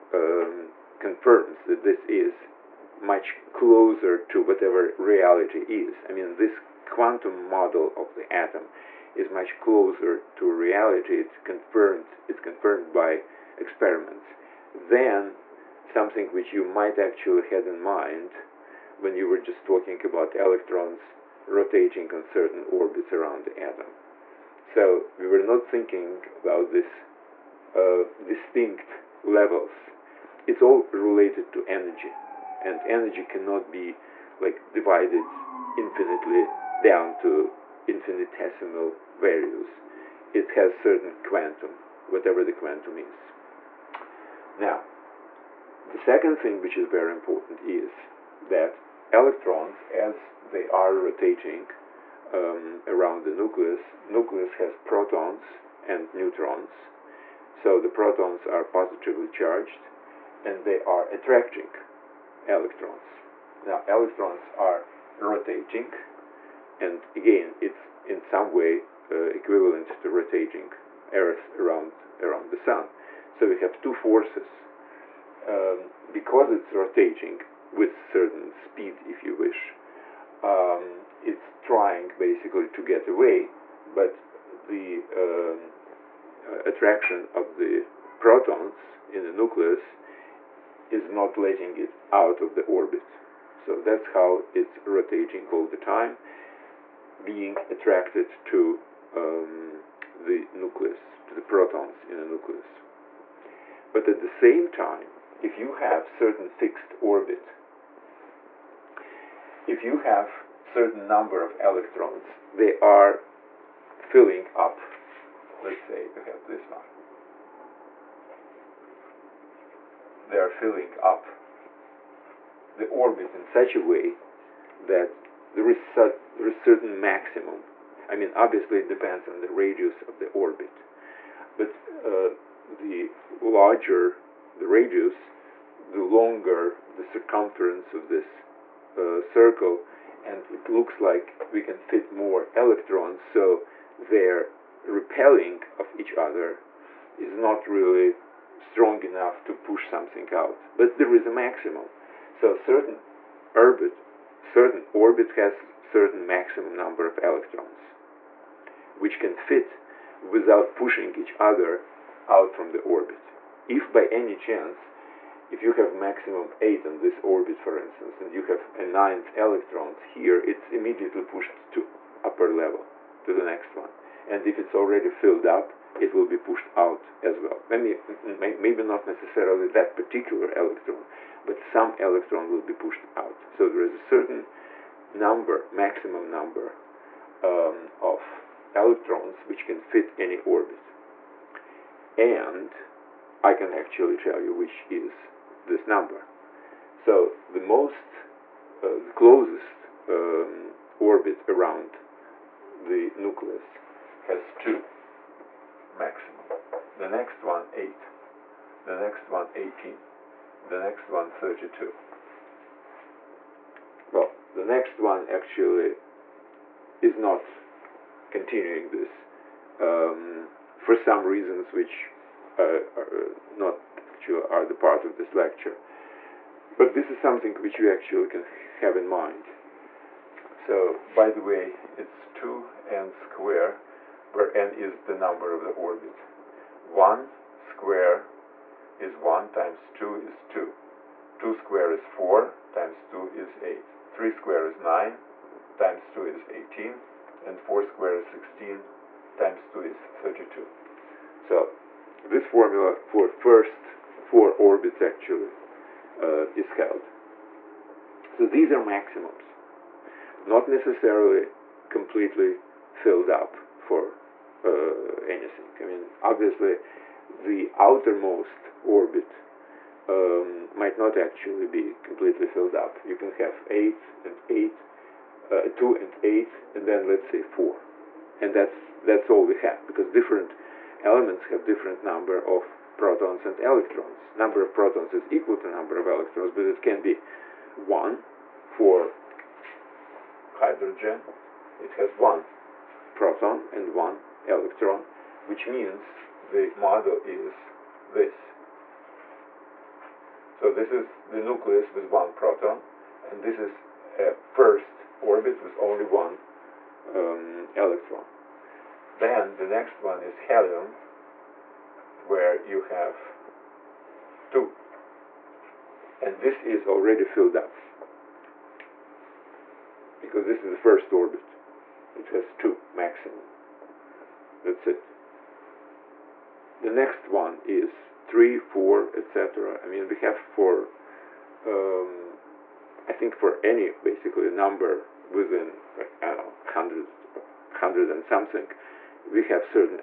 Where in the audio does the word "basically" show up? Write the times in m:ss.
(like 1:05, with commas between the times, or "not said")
1:22, 5:33.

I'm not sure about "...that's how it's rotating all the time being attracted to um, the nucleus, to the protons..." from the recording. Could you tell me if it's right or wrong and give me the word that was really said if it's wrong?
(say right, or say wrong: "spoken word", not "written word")
right.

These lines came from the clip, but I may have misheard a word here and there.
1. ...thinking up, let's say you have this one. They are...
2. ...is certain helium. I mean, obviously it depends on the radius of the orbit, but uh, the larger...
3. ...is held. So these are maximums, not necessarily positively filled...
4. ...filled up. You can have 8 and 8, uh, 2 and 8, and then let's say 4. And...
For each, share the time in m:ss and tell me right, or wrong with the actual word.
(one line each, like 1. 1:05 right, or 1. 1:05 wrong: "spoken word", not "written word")
1. 1:53 wrong: "filling", not "thinking"
2. 2:06 wrong: "maximum", not "helium"
3. 4:16 wrong: "completely", not "positively"
4. 4:32 right.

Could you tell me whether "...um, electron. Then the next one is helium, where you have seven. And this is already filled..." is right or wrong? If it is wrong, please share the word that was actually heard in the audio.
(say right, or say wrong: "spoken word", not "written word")
wrong: "two", not "seven".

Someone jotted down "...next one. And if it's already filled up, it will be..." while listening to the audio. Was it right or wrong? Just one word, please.
right.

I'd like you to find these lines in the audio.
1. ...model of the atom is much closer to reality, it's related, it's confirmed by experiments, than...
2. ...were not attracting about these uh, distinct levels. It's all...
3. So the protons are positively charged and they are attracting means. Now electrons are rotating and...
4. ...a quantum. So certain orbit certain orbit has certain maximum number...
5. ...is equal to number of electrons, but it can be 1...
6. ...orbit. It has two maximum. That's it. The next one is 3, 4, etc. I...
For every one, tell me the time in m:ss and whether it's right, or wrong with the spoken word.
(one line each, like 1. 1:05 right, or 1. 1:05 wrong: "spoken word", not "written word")
1. 0:07 wrong: "confirmed", not "related"
2. 0:25 wrong: "thinking", not "attracting"
3. 0:57 wrong: "electrons", not "means"
4. 2:31 wrong: "maximum", not "quantum"
5. 4:45 right
6. 5:21 right.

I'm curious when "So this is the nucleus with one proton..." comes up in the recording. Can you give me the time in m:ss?
5:00.